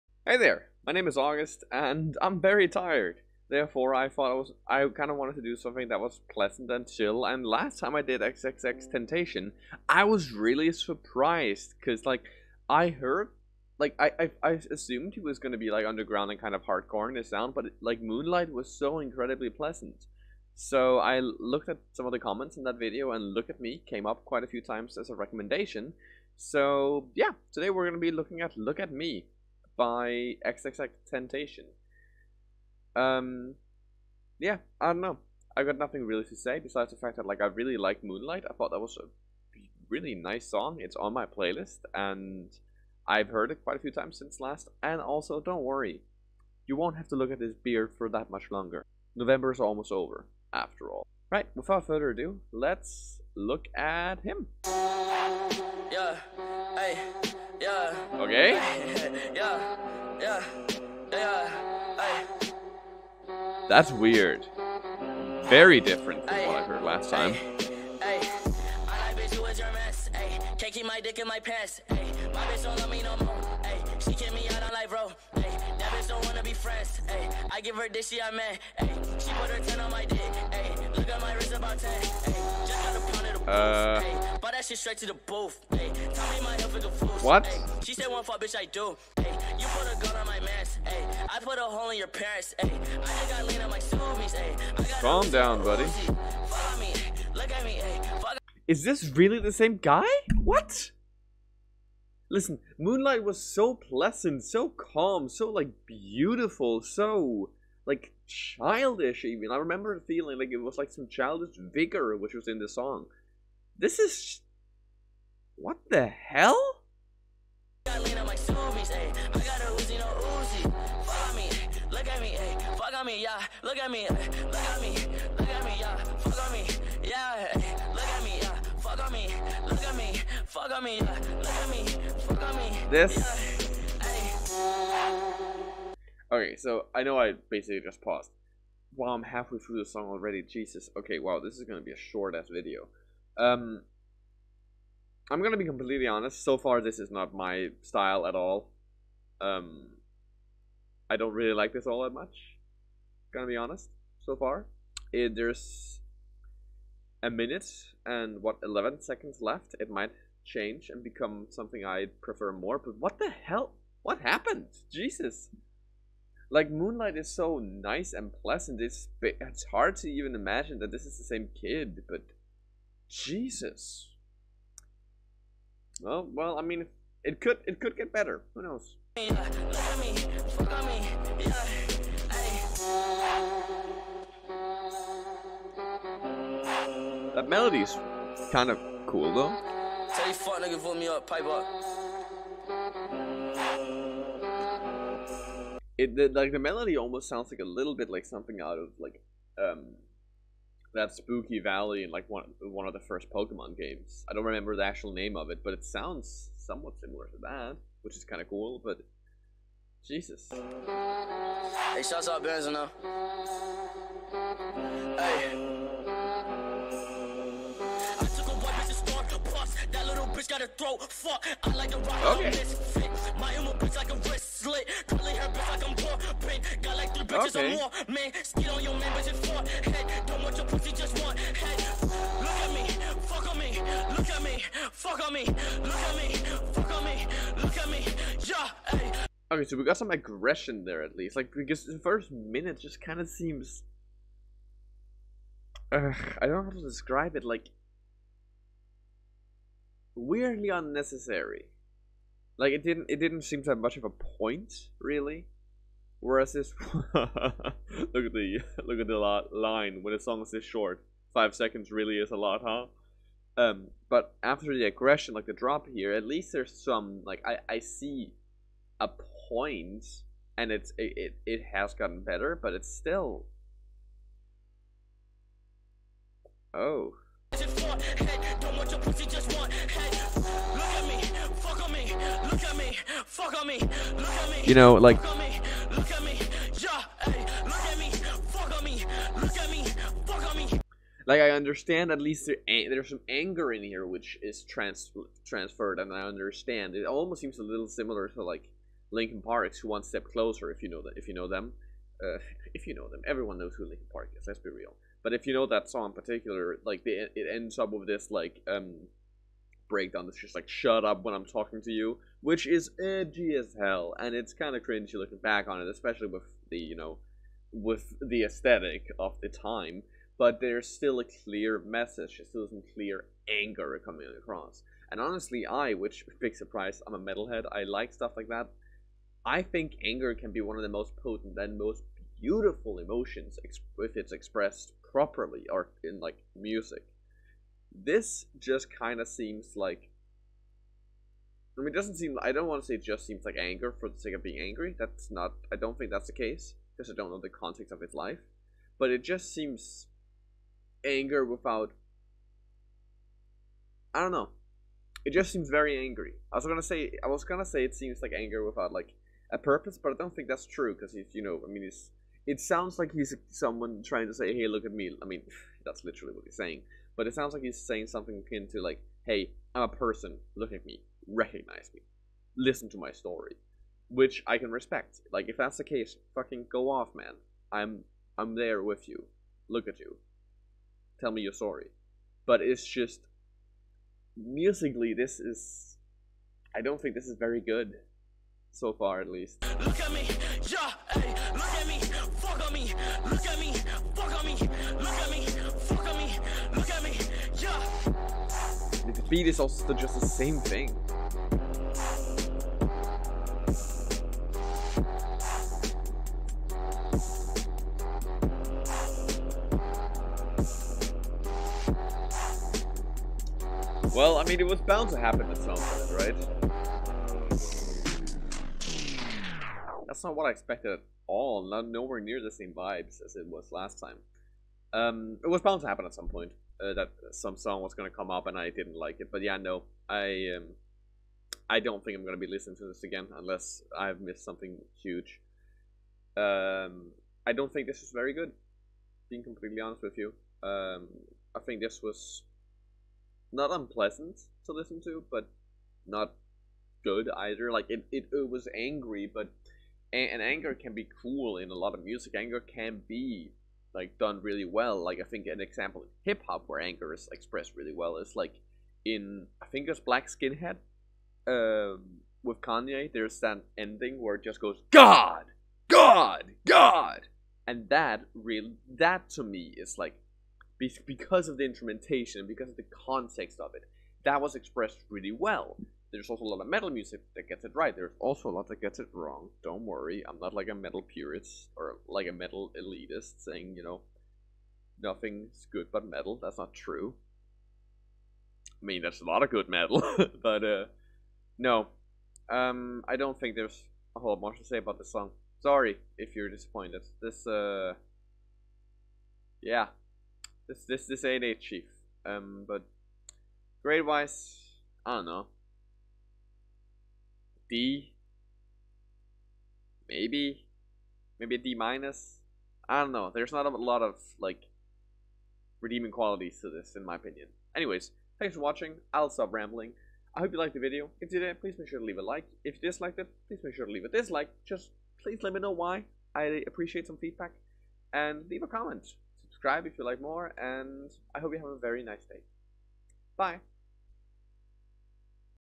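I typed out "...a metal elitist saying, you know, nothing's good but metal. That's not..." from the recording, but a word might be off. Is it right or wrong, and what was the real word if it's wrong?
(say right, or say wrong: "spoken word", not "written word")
right.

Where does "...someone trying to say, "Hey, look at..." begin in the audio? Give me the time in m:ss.
6:03.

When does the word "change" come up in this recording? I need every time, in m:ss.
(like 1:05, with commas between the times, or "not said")
2:40.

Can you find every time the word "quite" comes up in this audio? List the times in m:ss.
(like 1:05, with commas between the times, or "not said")
0:24, 0:43.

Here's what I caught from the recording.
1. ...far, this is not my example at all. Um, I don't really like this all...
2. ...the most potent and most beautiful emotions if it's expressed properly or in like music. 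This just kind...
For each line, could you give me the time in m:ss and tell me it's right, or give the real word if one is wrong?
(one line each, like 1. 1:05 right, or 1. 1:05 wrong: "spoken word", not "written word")
1. 2:26 wrong: "style", not "example"
2. 5:30 right.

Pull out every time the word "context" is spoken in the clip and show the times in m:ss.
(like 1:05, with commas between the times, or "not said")
5:47, 7:53.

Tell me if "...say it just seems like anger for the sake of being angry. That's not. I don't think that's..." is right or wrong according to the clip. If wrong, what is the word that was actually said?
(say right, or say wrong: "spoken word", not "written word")
right.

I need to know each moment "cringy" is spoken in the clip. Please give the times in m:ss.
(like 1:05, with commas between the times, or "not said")
5:14.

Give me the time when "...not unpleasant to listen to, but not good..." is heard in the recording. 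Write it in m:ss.
7:23.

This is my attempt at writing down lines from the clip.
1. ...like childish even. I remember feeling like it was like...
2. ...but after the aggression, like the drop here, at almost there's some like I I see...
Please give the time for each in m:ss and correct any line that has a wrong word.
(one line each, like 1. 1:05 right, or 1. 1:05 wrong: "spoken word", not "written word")
1. 1:47 right
2. 4:24 wrong: "least", not "almost".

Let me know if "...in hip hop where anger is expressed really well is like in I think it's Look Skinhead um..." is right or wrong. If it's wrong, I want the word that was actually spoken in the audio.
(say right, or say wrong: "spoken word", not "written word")
wrong: "Black", not "Look".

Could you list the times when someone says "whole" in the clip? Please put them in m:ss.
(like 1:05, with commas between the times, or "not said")
8:14.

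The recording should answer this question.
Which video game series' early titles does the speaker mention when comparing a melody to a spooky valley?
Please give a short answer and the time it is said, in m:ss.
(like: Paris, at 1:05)
Pokemon, at 3:23.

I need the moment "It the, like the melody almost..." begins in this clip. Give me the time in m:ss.
3:15.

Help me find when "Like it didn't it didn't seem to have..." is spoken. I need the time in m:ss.
4:12.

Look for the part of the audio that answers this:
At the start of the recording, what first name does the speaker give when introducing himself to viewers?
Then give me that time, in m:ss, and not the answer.
0:01.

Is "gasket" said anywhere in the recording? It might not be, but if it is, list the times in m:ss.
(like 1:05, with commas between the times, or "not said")
not said.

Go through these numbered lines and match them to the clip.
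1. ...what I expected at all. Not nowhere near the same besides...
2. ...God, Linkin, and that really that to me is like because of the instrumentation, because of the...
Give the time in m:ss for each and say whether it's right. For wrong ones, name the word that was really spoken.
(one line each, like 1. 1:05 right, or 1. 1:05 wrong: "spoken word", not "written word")
1. 7:00 wrong: "vibes", not "besides"
2. 7:45 wrong: "God", not "Linkin".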